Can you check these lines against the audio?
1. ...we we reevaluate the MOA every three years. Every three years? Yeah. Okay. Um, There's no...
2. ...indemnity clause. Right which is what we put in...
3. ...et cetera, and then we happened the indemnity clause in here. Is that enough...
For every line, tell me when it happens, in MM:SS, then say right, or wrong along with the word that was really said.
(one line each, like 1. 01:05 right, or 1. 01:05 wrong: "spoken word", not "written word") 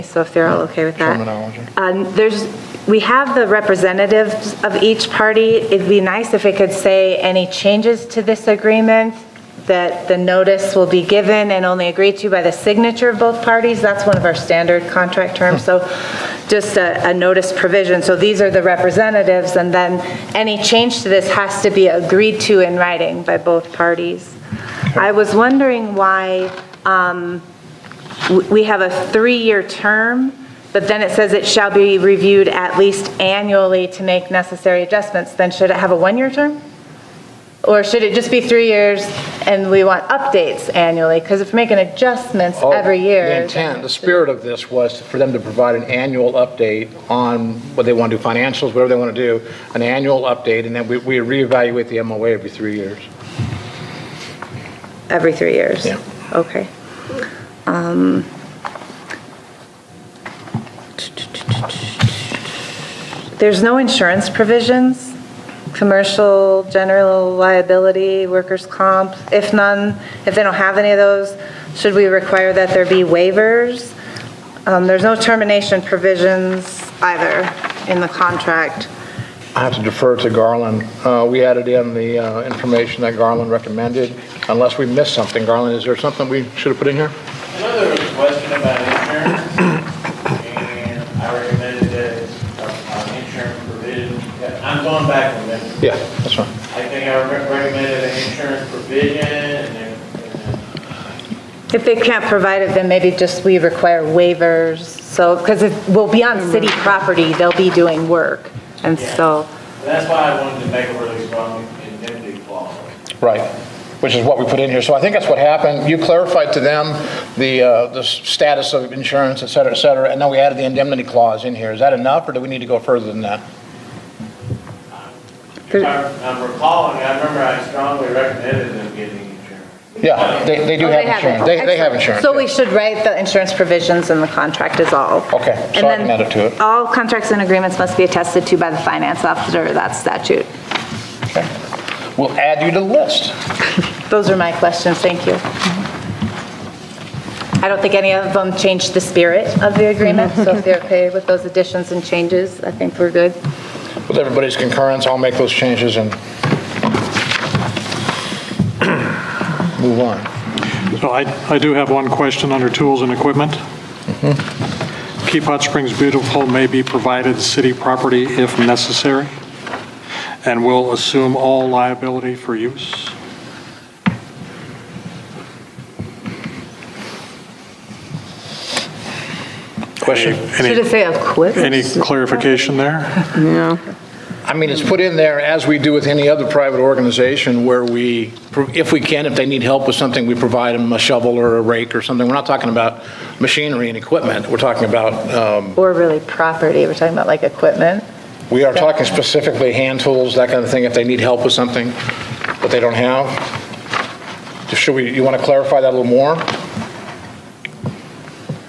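1. 00:50 right
2. 01:51 right
3. 01:59 wrong: "added", not "happened".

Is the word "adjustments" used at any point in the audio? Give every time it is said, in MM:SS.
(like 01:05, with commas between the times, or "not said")
00:34, 00:41.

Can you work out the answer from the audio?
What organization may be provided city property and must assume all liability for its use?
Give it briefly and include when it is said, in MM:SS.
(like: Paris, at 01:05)
Keep Hot Springs Beautiful, at 02:45.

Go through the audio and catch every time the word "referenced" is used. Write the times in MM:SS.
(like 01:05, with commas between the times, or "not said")
not said.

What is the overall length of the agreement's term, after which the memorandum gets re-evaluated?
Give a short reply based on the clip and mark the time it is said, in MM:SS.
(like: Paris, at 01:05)
3 years, at 00:29.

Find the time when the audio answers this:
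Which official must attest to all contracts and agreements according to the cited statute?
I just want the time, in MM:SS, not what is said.
02:18.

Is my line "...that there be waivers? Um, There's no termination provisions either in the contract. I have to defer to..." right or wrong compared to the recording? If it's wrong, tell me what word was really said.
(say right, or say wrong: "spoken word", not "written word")
right.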